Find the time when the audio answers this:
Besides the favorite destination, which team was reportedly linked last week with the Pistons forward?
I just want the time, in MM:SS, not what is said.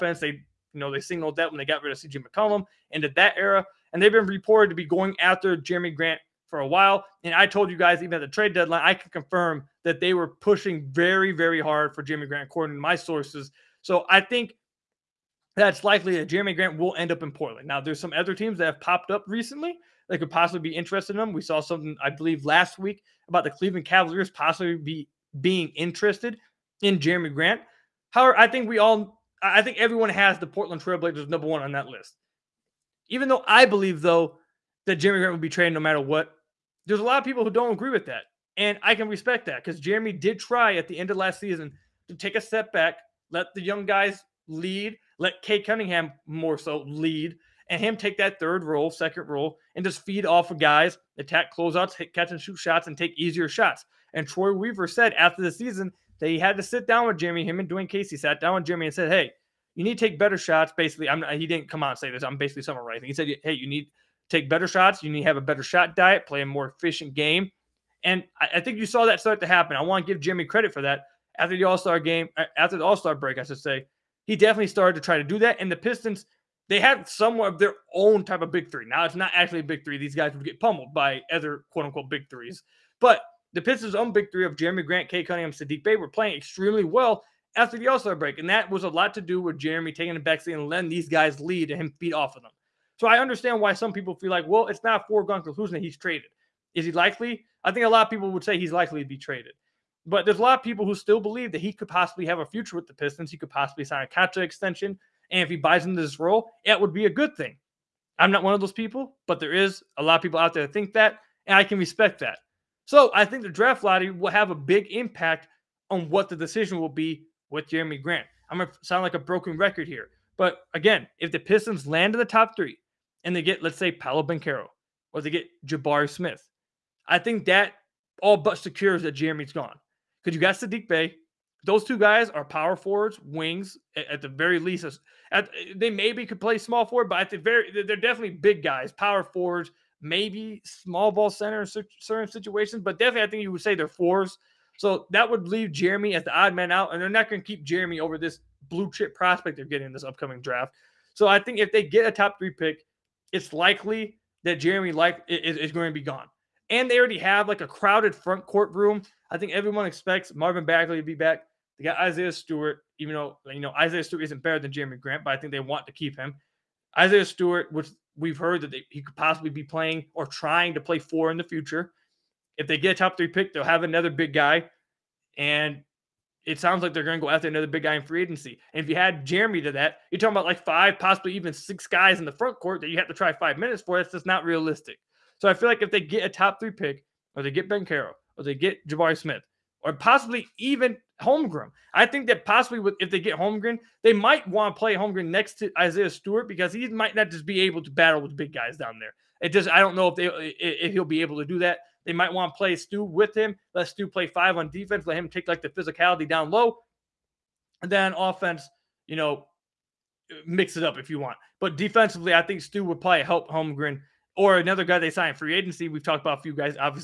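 00:23.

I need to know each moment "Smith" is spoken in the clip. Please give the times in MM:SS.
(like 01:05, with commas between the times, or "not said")
02:06, 03:09.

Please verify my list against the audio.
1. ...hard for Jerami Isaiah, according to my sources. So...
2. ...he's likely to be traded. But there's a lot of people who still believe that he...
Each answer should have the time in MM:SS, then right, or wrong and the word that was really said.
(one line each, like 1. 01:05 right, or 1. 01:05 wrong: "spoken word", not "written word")
1. 00:11 wrong: "Grant", not "Isaiah"
2. 01:38 right.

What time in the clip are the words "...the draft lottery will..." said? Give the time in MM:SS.
01:53.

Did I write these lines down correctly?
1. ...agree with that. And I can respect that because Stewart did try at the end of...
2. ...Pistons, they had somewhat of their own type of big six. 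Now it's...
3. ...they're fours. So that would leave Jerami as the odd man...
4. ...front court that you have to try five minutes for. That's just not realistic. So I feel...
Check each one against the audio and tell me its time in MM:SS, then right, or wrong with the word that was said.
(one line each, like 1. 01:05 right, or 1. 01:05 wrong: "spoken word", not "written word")
1. 00:37 wrong: "Jerami", not "Stewart"
2. 01:15 wrong: "three", not "six"
3. 02:23 right
4. 03:02 right.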